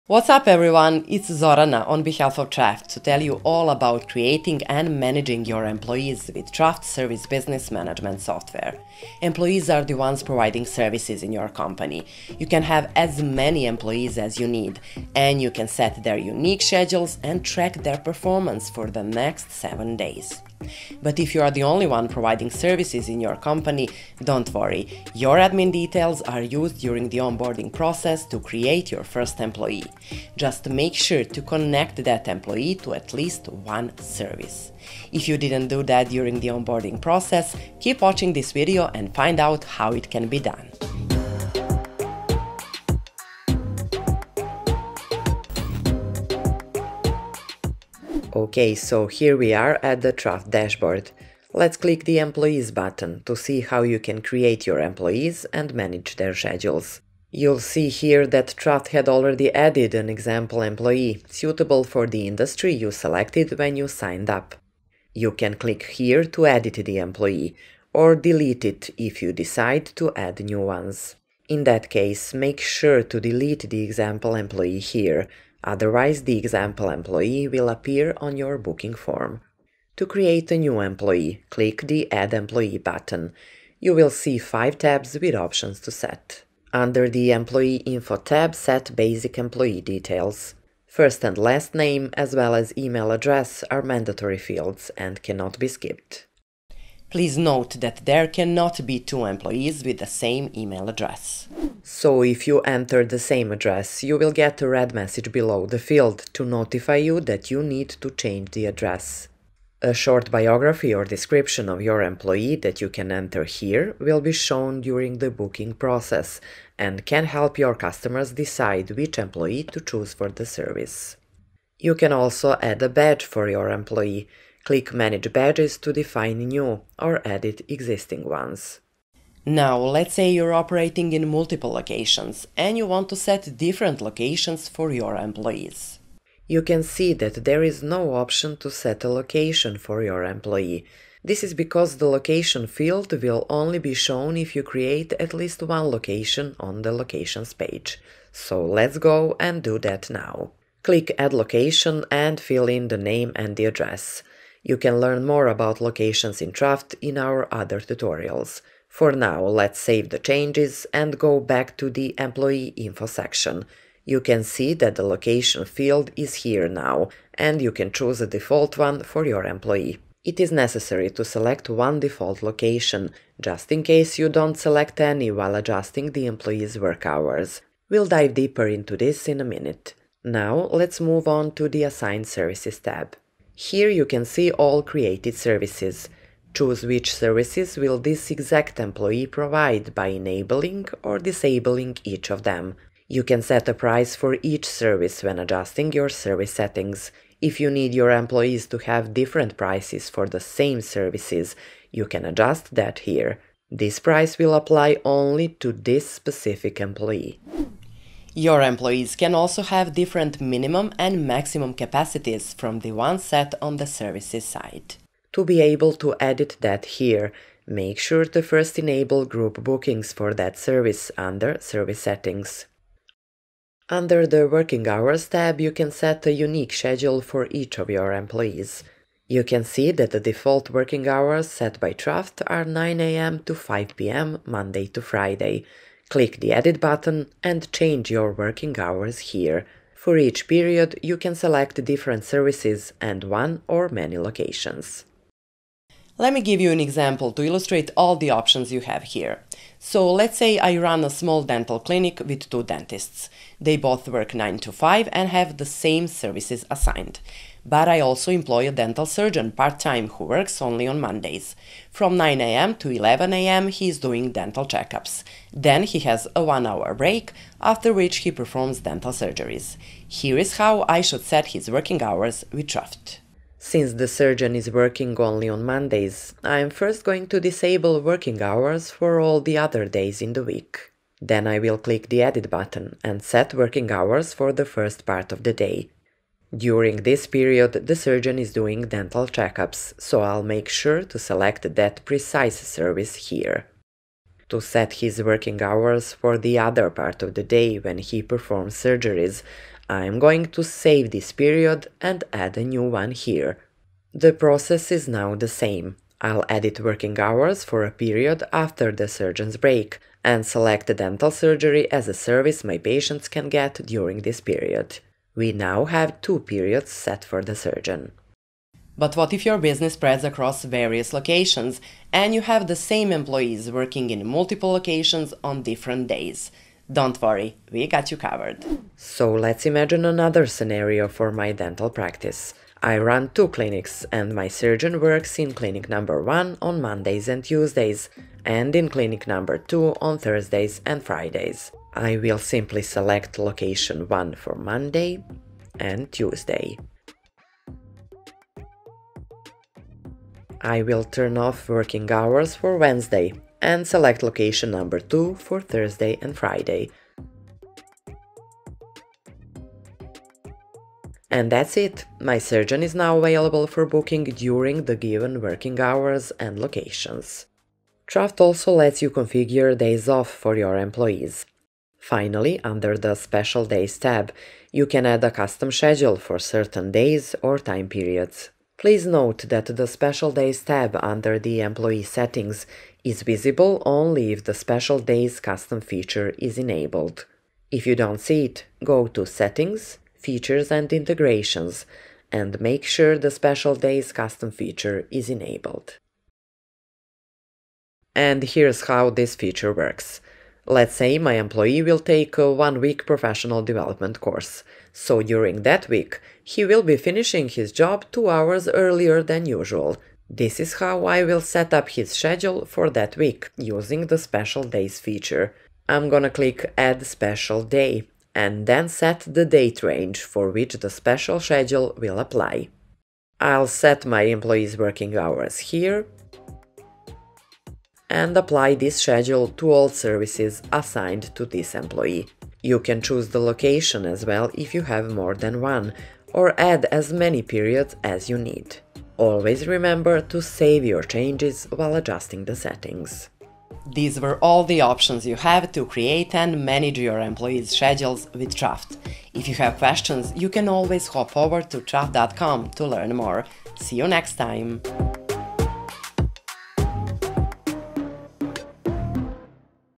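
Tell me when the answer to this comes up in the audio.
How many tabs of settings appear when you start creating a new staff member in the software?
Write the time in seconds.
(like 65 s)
84 s.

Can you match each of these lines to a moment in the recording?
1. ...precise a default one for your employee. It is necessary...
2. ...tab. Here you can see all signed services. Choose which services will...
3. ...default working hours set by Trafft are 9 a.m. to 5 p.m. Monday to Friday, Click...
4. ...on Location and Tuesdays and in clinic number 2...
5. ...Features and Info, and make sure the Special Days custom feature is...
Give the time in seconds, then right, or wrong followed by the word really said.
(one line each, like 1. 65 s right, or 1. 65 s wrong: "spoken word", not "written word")
1. 167 s wrong: "choose", not "precise"
2. 182 s wrong: "created", not "signed"
3. 230 s right
4. 336 s wrong: "Mondays", not "Location"
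5. 390 s wrong: "Integrations", not "Info".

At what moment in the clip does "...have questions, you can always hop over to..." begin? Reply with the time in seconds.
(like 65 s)
449 s.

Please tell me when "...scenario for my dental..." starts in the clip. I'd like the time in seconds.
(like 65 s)
330 s.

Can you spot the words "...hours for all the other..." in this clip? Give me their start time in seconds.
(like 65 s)
278 s.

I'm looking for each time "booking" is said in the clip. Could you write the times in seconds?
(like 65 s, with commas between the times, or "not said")
78 s, 115 s, 219 s, 363 s.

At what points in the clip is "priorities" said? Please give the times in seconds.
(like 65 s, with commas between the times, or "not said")
not said.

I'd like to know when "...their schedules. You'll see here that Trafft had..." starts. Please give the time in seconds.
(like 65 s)
56 s.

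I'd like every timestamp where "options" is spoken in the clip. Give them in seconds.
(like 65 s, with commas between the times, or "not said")
85 s, 138 s, 248 s, 444 s.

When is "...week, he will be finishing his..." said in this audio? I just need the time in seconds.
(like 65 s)
405 s.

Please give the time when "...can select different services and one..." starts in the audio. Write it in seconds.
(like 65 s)
241 s.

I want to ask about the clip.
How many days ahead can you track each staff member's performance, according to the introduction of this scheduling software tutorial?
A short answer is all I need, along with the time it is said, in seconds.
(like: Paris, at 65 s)
7, at 19 s.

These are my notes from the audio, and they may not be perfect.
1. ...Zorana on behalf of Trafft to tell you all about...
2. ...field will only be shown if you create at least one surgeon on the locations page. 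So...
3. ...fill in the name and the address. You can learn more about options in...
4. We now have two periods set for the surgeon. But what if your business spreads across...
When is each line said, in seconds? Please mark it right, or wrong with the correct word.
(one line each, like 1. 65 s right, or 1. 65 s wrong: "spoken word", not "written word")
1. 1 s right
2. 142 s wrong: "location", not "surgeon"
3. 152 s wrong: "locations", not "options"
4. 315 s right.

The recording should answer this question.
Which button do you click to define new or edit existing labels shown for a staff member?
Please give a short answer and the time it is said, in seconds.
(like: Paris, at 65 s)
Manage Badges, at 124 s.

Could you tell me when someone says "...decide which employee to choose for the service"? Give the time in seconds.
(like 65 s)
118 s.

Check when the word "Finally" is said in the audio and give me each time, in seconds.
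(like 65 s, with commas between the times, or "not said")
372 s.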